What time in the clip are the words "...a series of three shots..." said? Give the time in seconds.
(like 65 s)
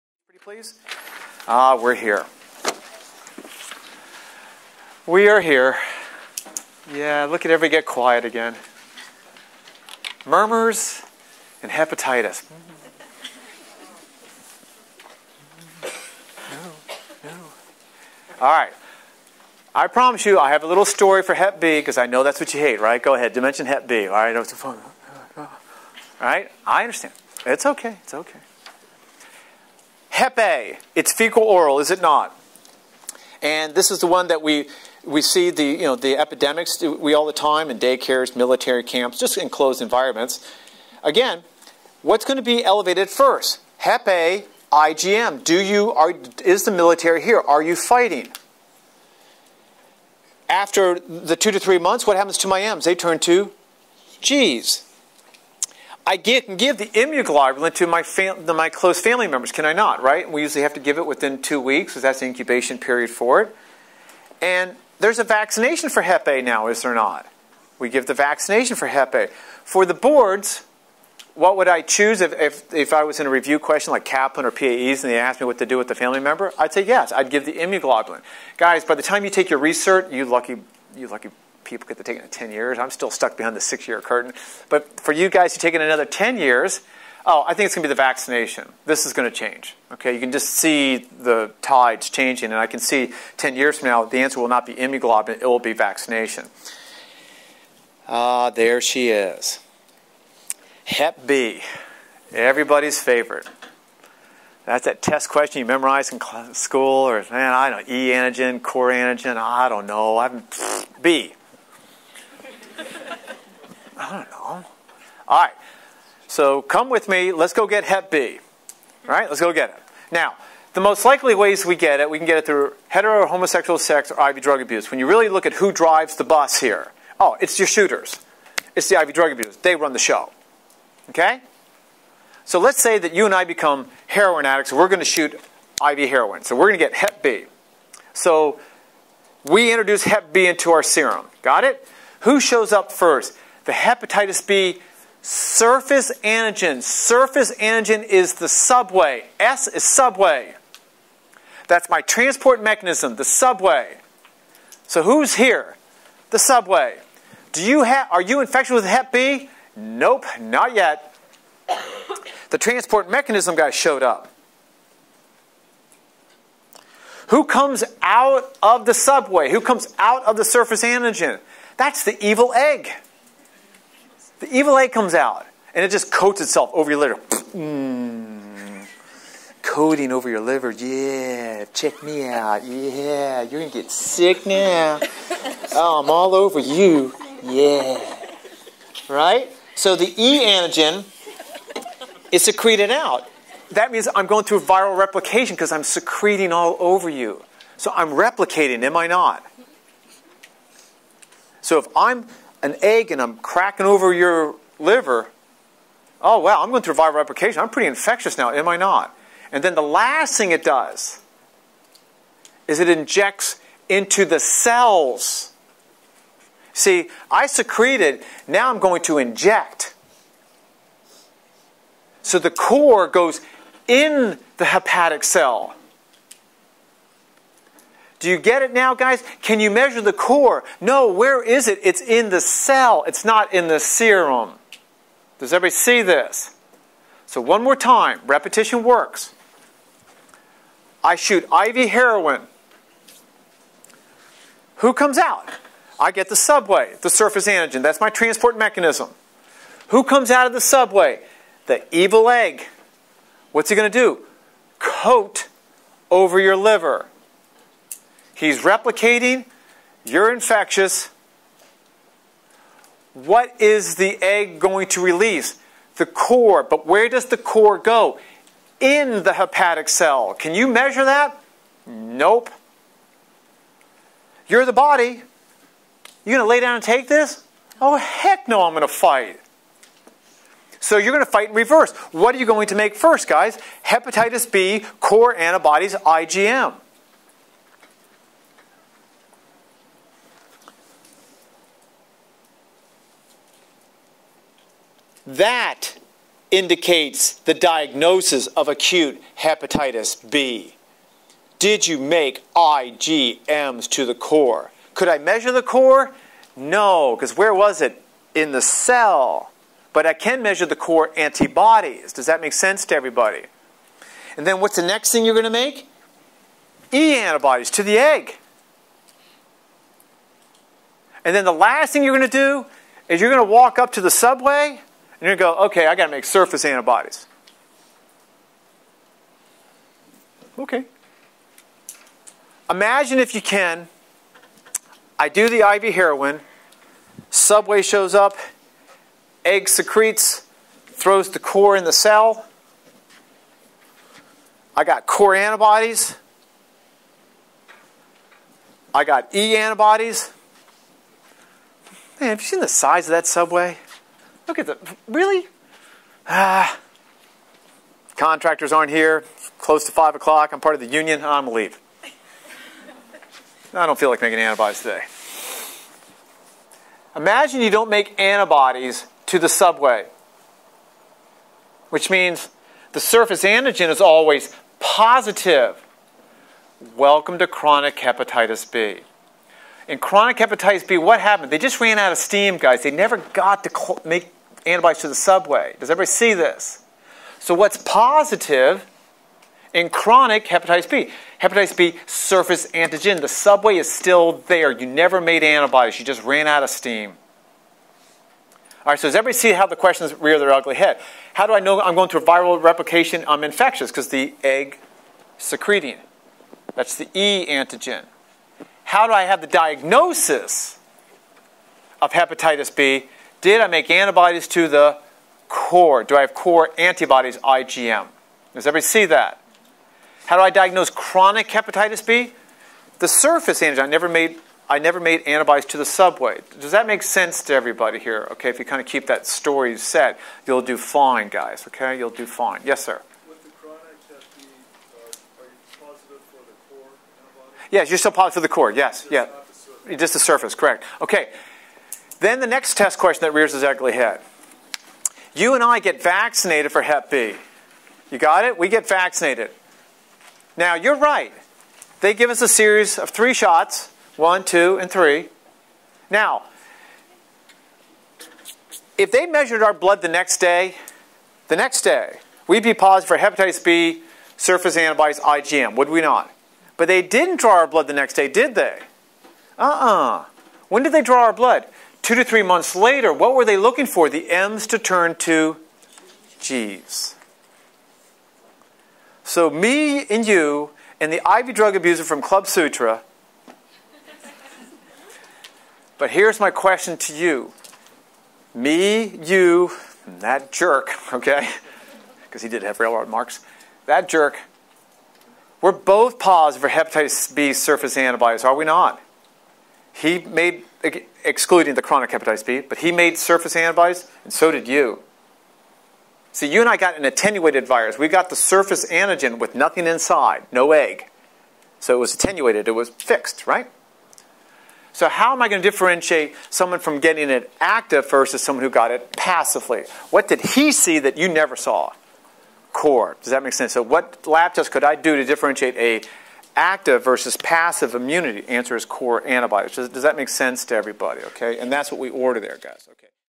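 452 s.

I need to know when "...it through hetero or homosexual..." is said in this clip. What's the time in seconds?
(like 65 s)
122 s.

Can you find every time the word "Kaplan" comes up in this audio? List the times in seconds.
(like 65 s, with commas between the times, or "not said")
74 s.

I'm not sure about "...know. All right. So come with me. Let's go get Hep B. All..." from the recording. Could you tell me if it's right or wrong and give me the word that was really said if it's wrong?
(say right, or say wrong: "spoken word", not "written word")
right.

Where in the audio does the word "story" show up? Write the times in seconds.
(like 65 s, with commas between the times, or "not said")
20 s, 429 s.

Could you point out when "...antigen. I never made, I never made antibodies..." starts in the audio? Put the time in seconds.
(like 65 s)
423 s.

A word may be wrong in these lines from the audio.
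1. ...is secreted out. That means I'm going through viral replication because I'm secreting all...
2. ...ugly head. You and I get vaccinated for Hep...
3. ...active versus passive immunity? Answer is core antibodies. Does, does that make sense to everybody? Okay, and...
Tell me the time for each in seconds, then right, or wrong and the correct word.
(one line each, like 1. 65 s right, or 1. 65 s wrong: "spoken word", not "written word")
1. 192 s right
2. 443 s right
3. 526 s right.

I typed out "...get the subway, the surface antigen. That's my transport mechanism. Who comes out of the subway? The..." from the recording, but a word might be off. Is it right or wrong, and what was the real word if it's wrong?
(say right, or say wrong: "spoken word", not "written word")
right.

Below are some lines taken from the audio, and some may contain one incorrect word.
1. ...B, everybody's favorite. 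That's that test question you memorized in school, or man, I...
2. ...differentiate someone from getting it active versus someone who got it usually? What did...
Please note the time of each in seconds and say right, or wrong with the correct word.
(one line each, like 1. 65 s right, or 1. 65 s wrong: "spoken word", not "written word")
1. 101 s right
2. 515 s wrong: "passively", not "usually".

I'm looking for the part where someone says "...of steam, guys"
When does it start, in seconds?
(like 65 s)
382 s.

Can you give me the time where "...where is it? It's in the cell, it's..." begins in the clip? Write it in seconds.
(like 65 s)
231 s.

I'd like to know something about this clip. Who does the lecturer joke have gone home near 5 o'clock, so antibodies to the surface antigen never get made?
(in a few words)
Contractors.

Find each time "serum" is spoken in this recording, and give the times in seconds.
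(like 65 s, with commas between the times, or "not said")
140 s, 233 s.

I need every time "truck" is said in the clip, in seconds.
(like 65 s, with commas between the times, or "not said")
not said.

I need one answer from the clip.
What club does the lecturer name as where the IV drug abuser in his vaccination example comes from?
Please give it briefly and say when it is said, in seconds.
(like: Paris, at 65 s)
Club Sutra, at 482 s.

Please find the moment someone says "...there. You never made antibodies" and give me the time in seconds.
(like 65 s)
394 s.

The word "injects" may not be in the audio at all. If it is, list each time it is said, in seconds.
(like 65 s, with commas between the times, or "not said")
212 s, 219 s.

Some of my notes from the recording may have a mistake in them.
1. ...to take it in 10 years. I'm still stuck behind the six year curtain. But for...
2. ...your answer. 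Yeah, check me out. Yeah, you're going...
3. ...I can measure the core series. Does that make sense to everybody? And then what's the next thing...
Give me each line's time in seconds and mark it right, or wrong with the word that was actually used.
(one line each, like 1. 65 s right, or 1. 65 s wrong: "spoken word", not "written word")
1. 81 s right
2. 180 s wrong: "liver", not "answer"
3. 310 s wrong: "antibodies", not "series".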